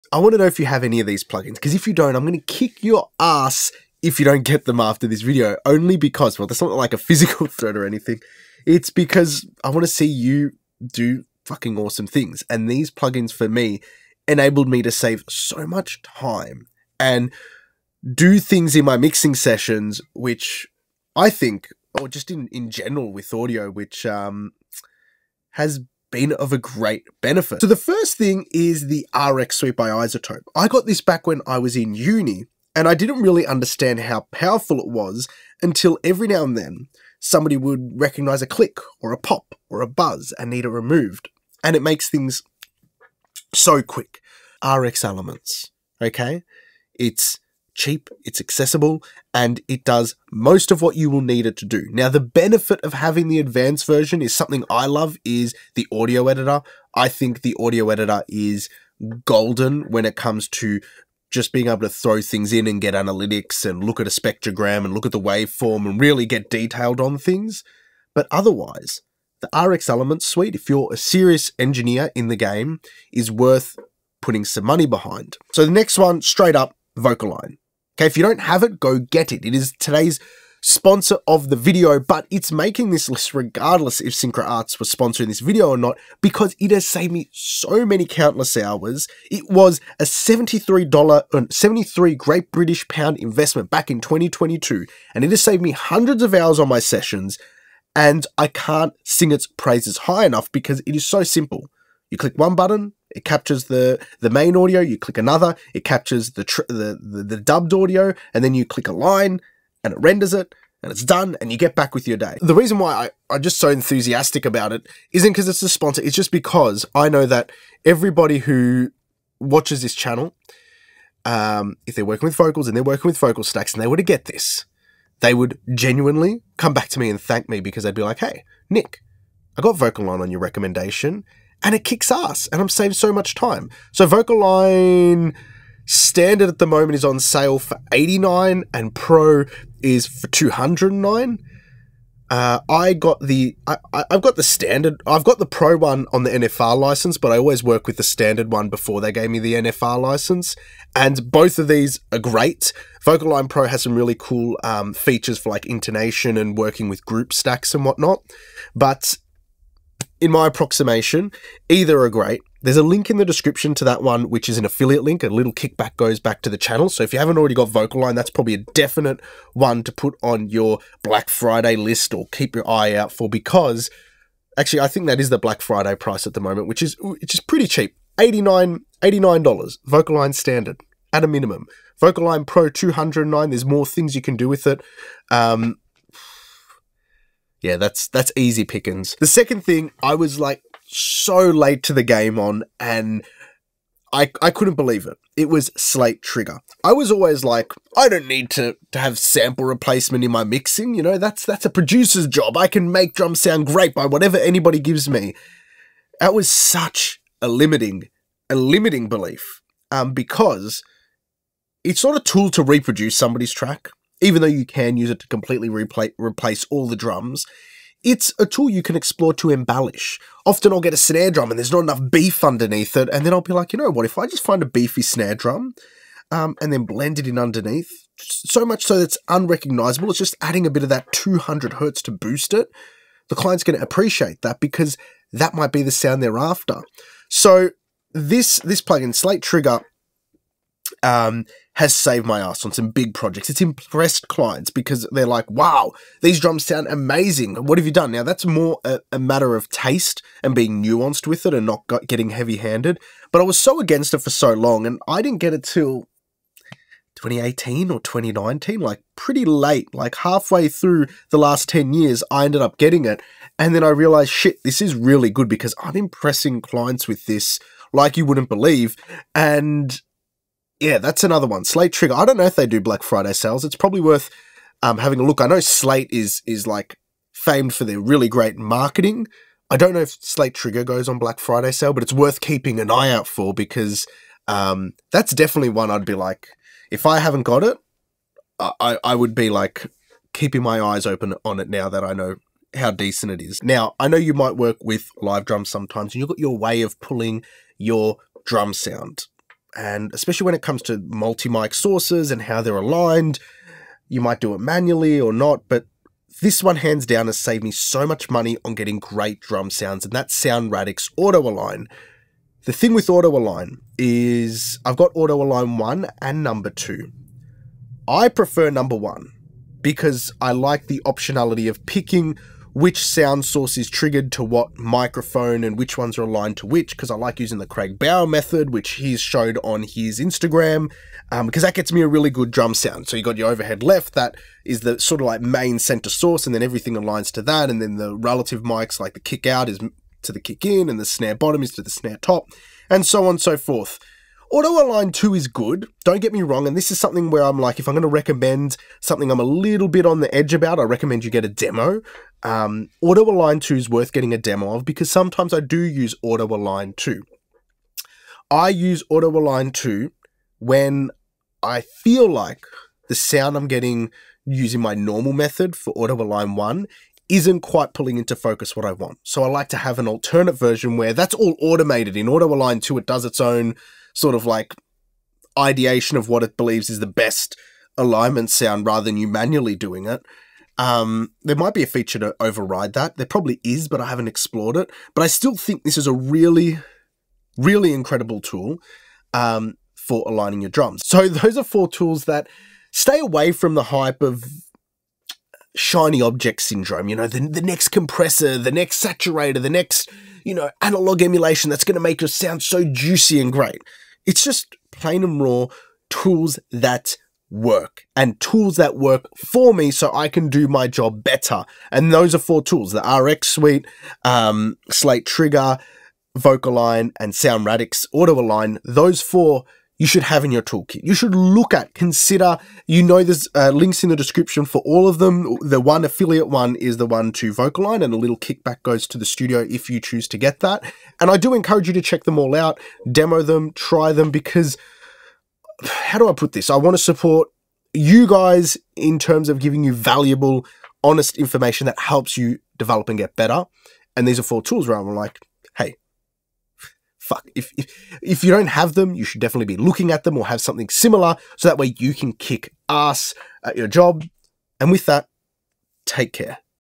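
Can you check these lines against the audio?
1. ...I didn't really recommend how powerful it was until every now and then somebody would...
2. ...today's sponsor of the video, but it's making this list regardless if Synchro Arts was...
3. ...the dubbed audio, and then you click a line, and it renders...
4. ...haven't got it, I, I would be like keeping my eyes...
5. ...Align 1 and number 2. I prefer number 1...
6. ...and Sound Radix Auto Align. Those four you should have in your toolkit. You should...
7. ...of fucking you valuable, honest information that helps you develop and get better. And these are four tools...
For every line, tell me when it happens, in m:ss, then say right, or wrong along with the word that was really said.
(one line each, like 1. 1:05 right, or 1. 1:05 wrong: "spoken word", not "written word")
1. 0:32 wrong: "understand", not "recommend"
2. 1:19 right
3. 1:47 right
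4. 4:47 right
5. 5:15 right
6. 6:57 right
7. 7:19 wrong: "giving", not "fucking".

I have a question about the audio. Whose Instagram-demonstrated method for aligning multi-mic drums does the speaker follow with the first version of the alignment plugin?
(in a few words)
Craig Bauer.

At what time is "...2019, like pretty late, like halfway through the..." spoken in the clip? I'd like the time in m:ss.
4:18.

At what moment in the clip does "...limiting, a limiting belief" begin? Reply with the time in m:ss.
3:27.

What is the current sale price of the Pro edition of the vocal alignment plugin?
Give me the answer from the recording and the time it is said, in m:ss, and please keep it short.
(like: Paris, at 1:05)
209, at 2:18.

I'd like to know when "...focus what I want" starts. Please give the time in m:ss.
6:08.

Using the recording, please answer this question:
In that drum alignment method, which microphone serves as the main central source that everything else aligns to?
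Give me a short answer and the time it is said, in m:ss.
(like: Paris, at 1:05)
overhead left, at 5:33.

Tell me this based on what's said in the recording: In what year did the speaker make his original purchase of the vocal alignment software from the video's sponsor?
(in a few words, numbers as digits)
2022.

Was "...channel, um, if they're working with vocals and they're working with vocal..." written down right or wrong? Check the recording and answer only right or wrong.
right.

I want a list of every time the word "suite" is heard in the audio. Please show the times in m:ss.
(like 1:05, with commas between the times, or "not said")
0:29, 1:10, 6:53.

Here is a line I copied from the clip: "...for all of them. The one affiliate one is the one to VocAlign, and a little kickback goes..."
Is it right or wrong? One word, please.
right.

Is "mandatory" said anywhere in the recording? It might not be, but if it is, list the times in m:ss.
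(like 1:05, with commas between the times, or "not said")
not said.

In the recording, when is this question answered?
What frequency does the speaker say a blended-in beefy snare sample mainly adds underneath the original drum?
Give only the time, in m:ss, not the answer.
3:51.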